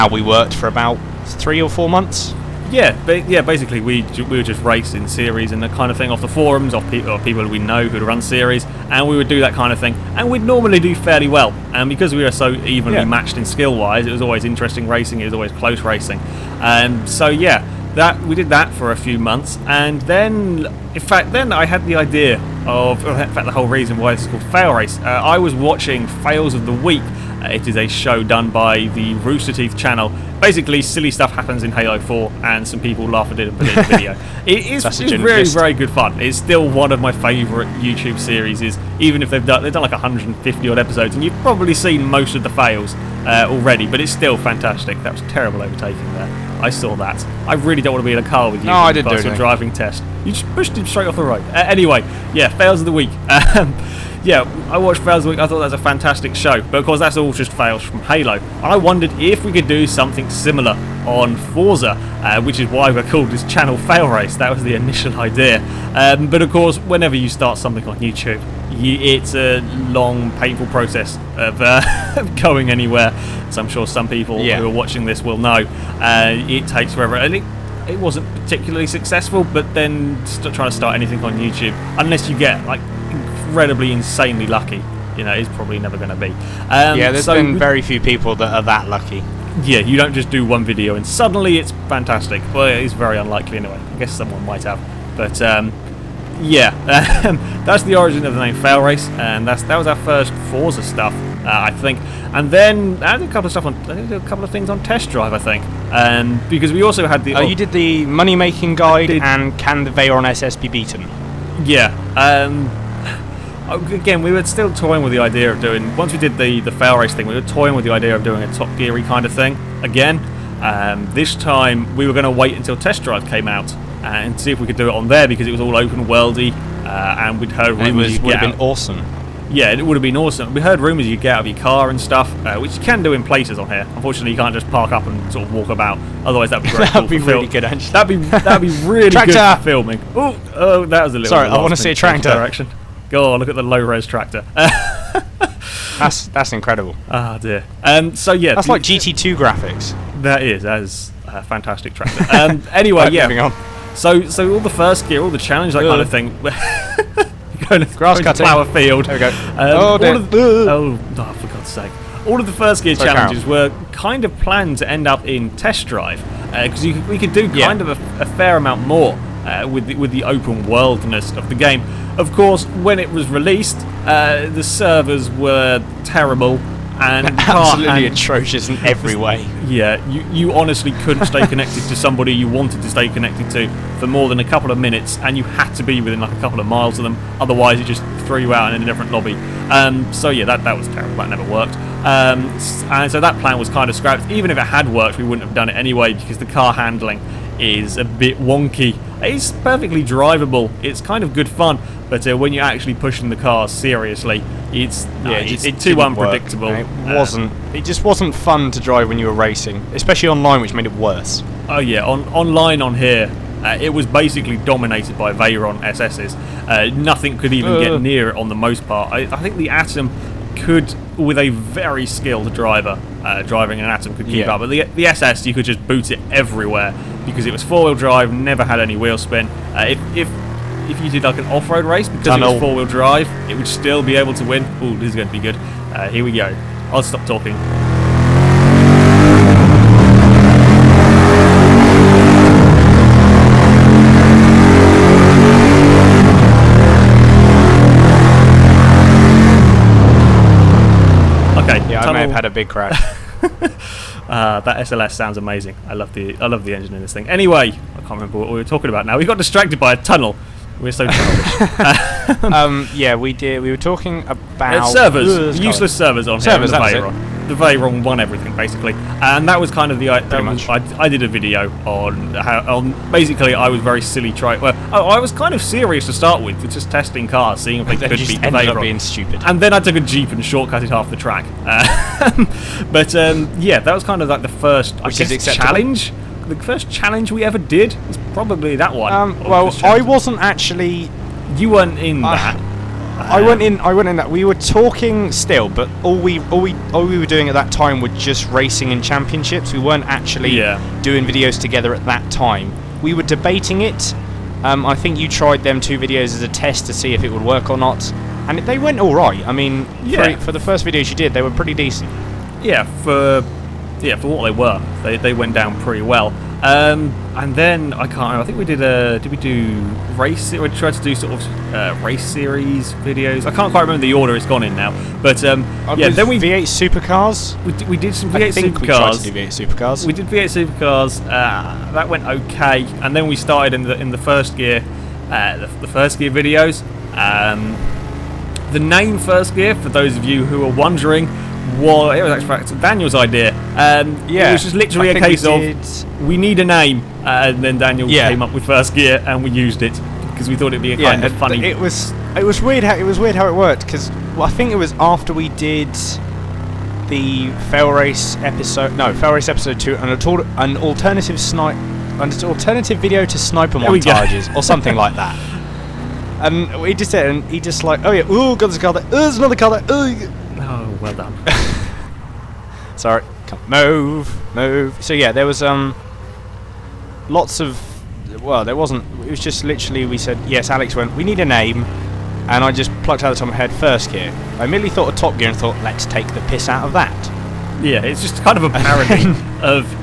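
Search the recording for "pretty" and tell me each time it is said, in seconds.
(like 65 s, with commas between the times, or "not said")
311 s, 315 s.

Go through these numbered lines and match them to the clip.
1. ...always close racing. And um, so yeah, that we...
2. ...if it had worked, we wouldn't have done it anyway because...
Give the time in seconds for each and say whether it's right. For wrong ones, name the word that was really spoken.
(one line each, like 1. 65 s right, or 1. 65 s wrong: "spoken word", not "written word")
1. 15 s right
2. 194 s right.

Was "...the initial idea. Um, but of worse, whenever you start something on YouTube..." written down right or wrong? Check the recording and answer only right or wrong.
wrong.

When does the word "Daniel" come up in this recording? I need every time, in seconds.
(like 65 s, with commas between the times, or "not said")
342 s, 347 s.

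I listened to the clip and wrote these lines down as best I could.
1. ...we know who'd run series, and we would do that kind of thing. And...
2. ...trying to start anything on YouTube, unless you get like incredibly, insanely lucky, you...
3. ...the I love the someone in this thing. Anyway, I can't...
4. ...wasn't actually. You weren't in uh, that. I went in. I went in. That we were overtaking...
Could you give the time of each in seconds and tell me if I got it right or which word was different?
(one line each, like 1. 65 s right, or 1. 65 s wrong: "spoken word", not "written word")
1. 7 s right
2. 80 s right
3. 256 s wrong: "engine", not "someone"
4. 290 s wrong: "talking", not "overtaking".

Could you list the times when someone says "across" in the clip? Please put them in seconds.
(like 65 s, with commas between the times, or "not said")
not said.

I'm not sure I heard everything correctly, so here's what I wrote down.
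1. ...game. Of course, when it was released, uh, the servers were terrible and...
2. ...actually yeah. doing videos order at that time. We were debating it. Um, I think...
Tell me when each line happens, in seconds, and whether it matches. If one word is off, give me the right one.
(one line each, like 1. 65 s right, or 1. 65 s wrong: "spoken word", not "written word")
1. 171 s right
2. 300 s wrong: "together", not "order".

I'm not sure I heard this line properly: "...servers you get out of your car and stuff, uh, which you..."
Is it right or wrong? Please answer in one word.
wrong.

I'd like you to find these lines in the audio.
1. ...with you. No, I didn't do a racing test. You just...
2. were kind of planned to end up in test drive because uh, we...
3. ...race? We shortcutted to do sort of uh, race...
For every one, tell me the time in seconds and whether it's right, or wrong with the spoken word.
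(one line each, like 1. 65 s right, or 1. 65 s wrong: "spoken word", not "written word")
1. 48 s wrong: "driving", not "racing"
2. 163 s right
3. 320 s wrong: "tried", not "shortcutted".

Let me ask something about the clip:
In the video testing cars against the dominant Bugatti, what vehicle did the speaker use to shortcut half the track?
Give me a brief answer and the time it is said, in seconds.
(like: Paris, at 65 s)
A jeep, at 279 s.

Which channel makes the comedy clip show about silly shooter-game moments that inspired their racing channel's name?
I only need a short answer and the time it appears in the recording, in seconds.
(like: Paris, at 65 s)
Rooster Teeth, at 29 s.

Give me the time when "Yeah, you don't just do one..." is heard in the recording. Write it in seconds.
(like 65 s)
89 s.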